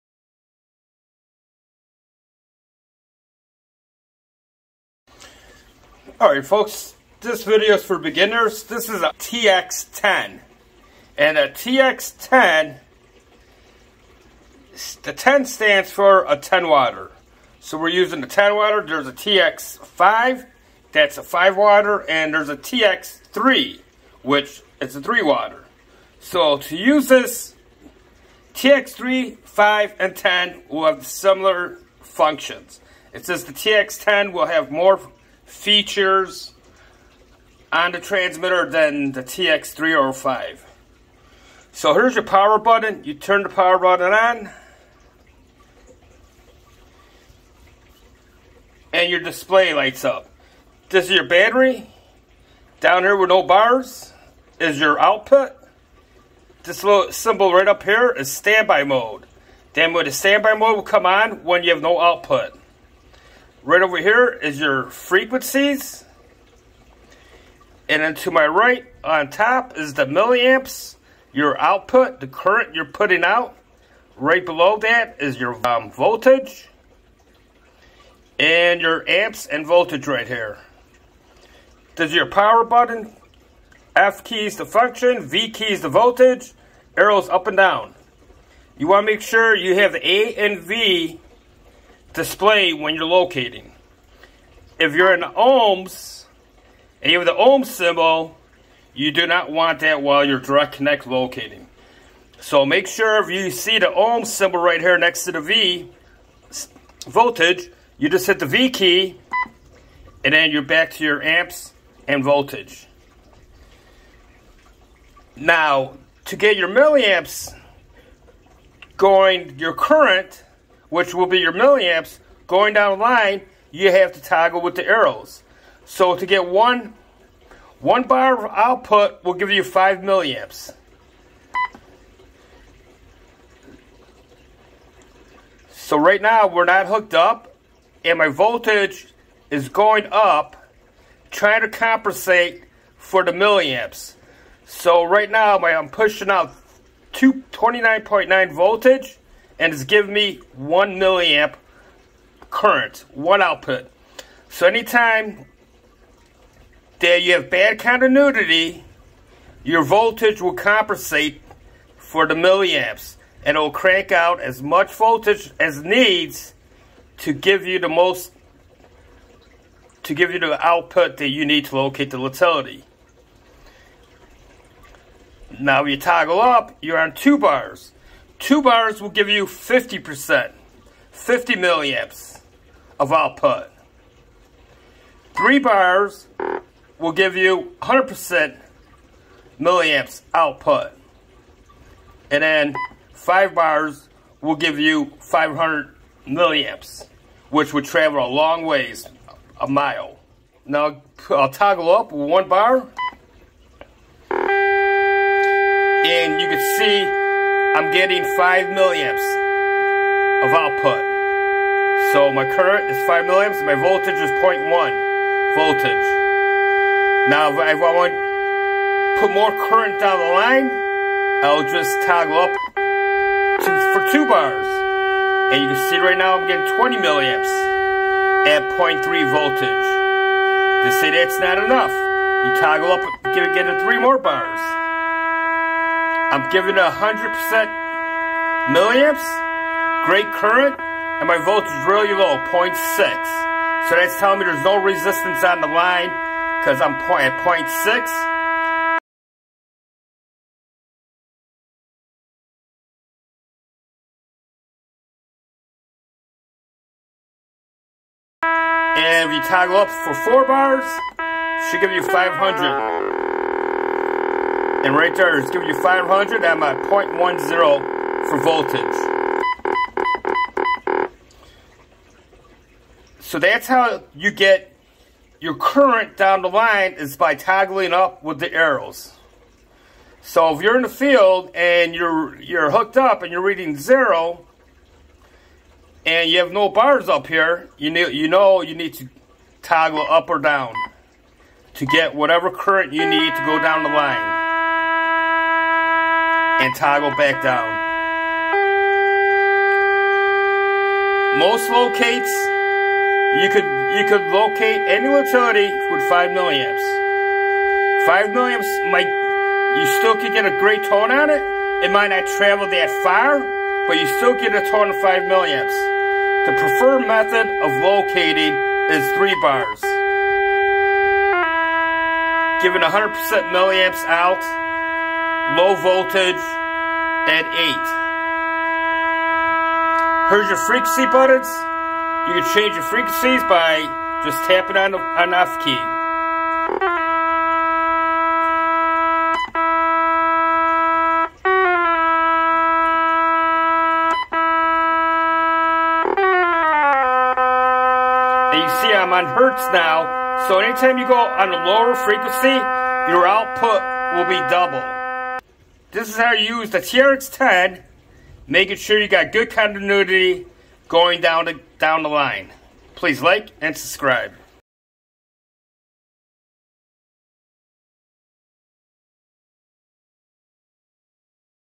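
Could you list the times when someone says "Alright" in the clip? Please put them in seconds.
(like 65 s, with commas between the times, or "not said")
6 s.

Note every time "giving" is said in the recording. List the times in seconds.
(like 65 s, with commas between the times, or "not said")
149 s, 236 s, 265 s, 322 s.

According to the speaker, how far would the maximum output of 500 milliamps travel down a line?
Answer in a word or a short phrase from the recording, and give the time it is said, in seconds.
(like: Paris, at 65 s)
A mile, at 199 s.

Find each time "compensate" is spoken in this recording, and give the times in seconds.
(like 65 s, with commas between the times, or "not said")
141 s, 160 s.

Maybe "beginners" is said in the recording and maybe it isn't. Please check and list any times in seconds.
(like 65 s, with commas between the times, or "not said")
7 s.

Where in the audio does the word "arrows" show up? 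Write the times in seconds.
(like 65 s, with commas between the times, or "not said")
86 s, 124 s, 278 s.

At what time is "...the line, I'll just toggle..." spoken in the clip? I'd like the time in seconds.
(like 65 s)
220 s.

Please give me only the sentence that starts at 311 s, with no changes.
It might not travel that far, but you still get a tone of 5 milliamps.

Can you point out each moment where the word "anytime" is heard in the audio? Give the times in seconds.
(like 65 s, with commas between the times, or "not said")
154 s, 350 s.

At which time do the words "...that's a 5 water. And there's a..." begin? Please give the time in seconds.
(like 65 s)
20 s.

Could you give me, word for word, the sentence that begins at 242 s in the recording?
So that's telling me there's no resistance on the line because I'm at 0.6.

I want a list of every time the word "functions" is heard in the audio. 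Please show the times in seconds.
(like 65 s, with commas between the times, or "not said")
32 s, 84 s.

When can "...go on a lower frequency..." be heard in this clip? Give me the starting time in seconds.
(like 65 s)
351 s.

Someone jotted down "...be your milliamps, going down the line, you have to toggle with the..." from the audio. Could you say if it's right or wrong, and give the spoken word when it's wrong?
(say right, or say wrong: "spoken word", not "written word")
right.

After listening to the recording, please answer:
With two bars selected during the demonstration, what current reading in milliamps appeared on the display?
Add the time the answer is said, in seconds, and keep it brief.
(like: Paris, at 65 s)
20 milliamps, at 226 s.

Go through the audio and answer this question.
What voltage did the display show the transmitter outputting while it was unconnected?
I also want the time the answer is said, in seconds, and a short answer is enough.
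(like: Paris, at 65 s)
229.9, at 147 s.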